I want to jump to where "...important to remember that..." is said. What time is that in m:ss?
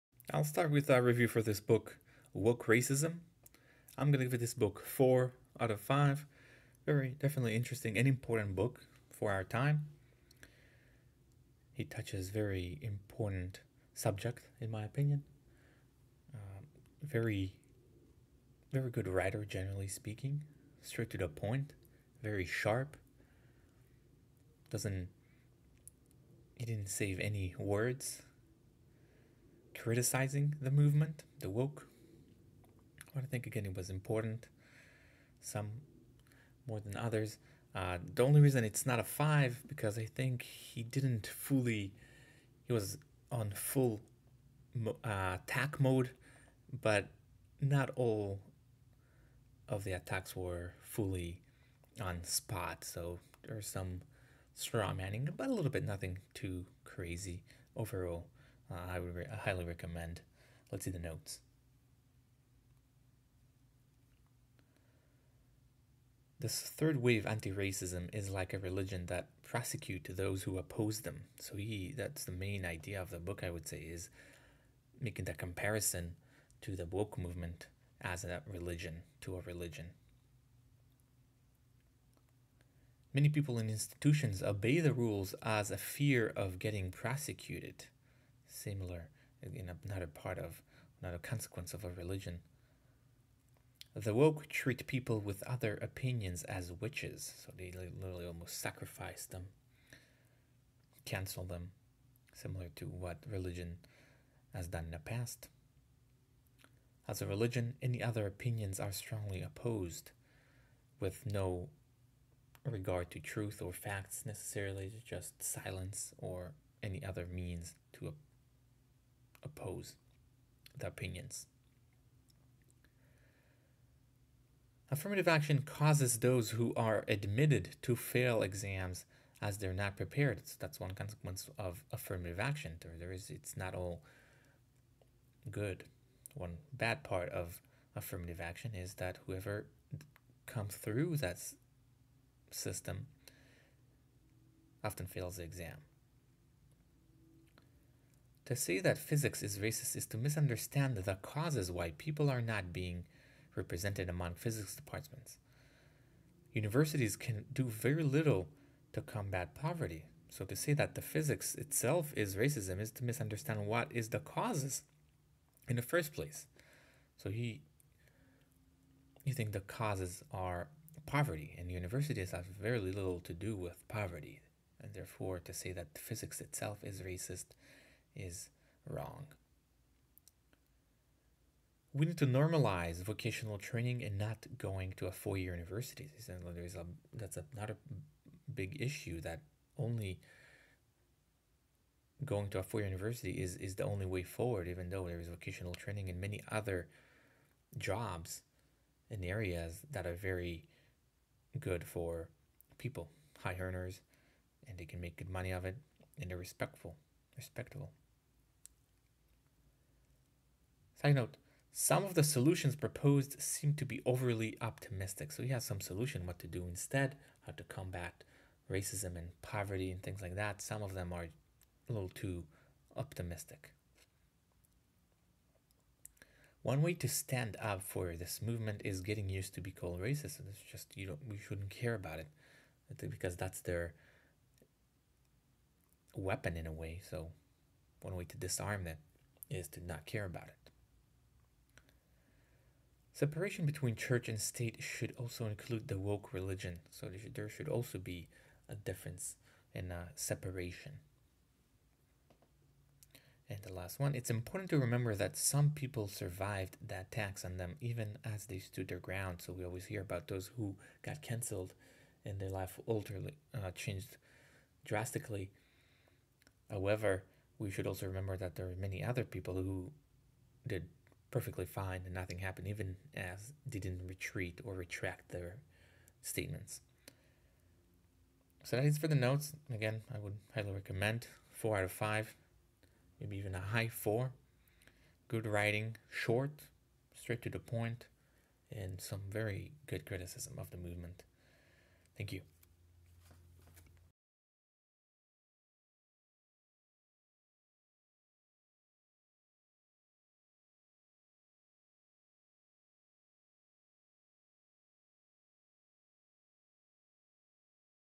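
4:14.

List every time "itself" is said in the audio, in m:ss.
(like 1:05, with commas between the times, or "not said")
2:41, 2:56.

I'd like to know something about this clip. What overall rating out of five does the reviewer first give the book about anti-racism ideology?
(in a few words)
4.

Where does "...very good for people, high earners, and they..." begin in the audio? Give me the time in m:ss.
3:20.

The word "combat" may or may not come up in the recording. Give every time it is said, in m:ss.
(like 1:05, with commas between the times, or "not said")
2:39, 3:37.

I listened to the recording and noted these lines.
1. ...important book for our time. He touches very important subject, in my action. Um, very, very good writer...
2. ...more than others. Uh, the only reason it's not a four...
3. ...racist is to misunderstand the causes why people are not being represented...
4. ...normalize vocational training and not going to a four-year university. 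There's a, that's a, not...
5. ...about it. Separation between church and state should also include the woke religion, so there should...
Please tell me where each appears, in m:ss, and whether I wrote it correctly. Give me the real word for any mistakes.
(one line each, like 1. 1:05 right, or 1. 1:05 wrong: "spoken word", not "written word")
1. 0:08 wrong: "opinion", not "action"
2. 0:36 wrong: "five", not "four"
3. 2:29 right
4. 3:02 right
5. 4:00 right.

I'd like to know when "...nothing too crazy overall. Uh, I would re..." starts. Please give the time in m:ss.
0:55.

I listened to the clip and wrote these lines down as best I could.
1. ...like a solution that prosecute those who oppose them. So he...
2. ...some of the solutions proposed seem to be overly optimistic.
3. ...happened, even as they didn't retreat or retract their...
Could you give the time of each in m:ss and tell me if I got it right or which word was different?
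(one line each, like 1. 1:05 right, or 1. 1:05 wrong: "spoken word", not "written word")
1. 1:08 wrong: "religion", not "solution"
2. 3:31 right
3. 4:32 right.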